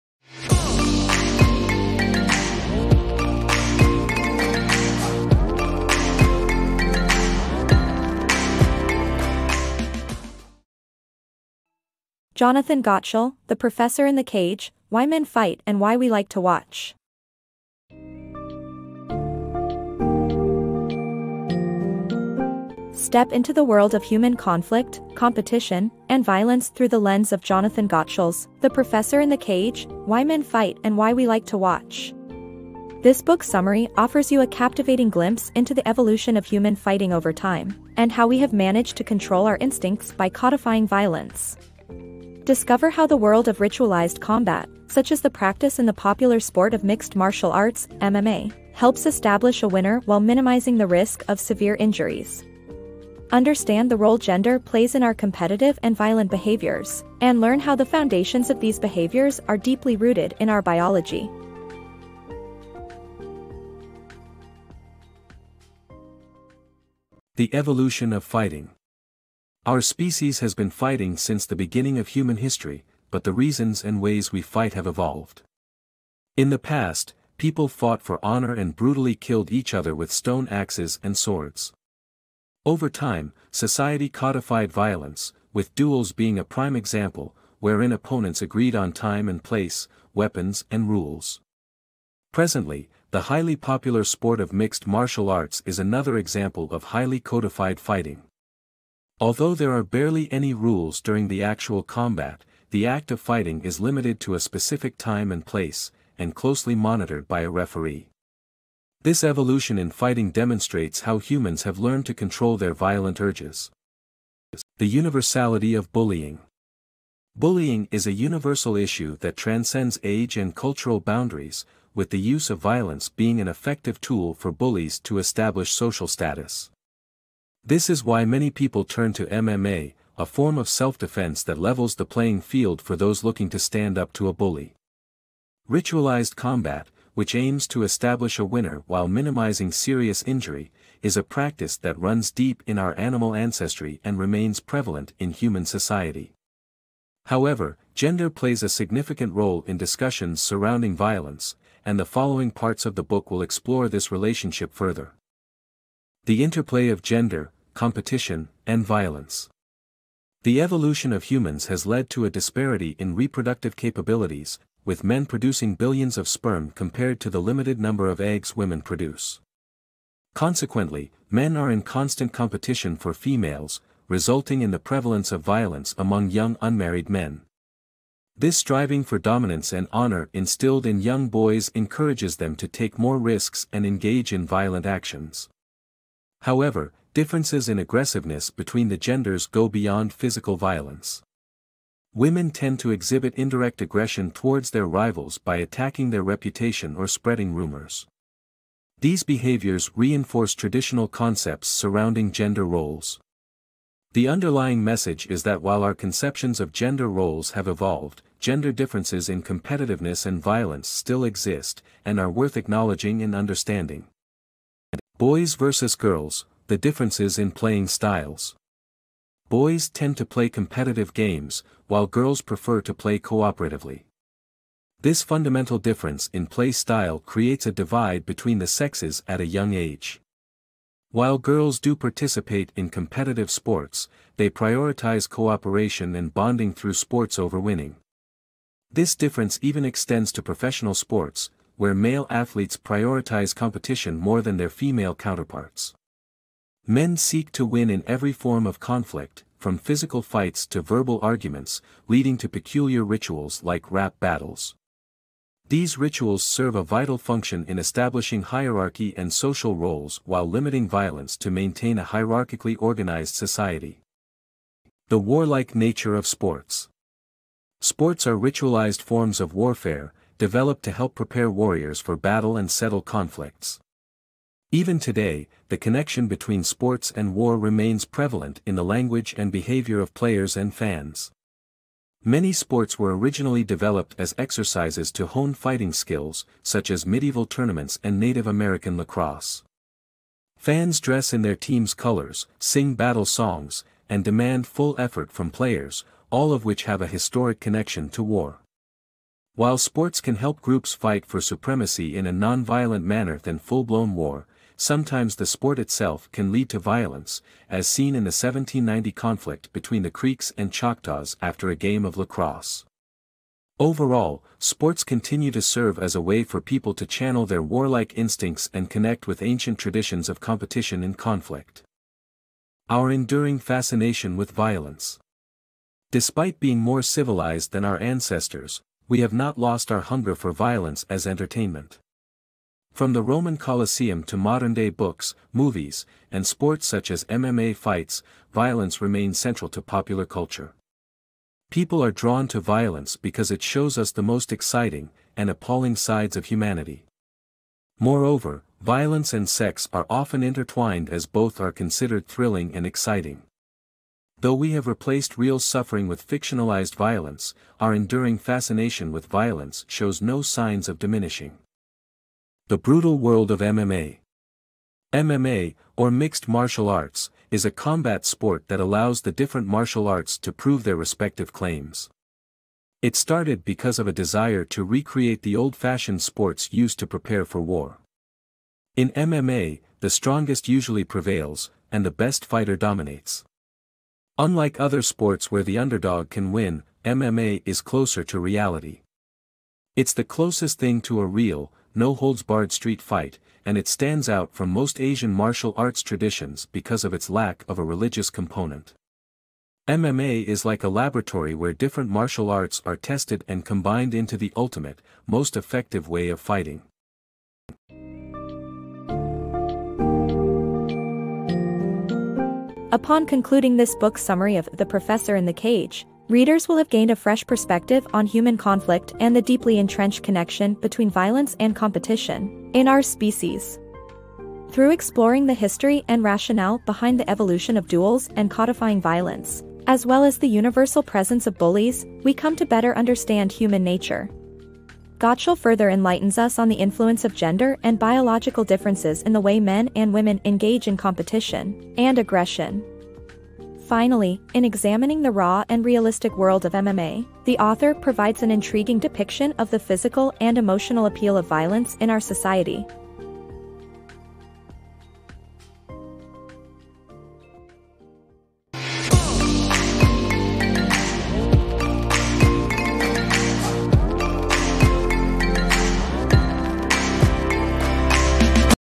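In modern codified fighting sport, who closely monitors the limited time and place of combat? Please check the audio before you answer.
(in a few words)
a referee.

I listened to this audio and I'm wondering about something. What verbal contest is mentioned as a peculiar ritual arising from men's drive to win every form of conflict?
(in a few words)
rap battles.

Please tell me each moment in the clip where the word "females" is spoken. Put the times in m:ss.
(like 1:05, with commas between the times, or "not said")
2:53, 4:04.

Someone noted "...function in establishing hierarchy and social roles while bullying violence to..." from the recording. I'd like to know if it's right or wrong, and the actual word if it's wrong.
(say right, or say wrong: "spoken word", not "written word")
wrong: "limiting", not "bullying".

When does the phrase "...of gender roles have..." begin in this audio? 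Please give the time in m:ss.
3:26.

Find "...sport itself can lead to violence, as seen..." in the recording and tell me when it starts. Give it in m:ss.
5:05.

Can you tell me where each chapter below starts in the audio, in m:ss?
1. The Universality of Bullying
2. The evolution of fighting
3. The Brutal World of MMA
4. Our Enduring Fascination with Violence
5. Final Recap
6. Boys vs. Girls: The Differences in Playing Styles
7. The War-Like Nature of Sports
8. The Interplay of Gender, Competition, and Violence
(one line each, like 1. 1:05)
1. 1:55
2. 1:08
3. 6:03
4. 5:23
5. 6:48
6. 3:35
7. 4:25
8. 2:36.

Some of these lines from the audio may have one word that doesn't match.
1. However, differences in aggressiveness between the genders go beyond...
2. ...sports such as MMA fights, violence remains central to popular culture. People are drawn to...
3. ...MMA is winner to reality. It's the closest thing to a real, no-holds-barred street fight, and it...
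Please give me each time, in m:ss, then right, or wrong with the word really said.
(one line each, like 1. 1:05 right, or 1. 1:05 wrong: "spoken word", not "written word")
1. 3:06 right
2. 5:36 right
3. 6:27 wrong: "closer", not "winner".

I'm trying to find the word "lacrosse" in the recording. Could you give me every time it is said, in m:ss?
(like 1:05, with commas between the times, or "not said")
4:48, 5:12.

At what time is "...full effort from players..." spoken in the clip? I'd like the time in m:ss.
4:54.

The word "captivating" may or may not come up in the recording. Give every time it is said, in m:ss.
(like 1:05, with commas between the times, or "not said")
0:34.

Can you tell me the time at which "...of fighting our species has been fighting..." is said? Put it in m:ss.
1:08.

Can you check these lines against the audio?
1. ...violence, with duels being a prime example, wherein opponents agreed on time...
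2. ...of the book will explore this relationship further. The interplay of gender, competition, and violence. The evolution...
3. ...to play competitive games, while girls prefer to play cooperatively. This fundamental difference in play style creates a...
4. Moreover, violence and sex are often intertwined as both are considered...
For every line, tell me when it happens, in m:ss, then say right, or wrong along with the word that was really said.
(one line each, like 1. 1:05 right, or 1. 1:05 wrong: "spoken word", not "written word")
1. 1:24 right
2. 2:32 right
3. 3:40 right
4. 5:47 right.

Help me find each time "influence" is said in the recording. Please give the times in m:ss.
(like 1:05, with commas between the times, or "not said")
7:16.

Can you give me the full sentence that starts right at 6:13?
It started because of a desire to recreate the old-fashioned sports used to prepare for war.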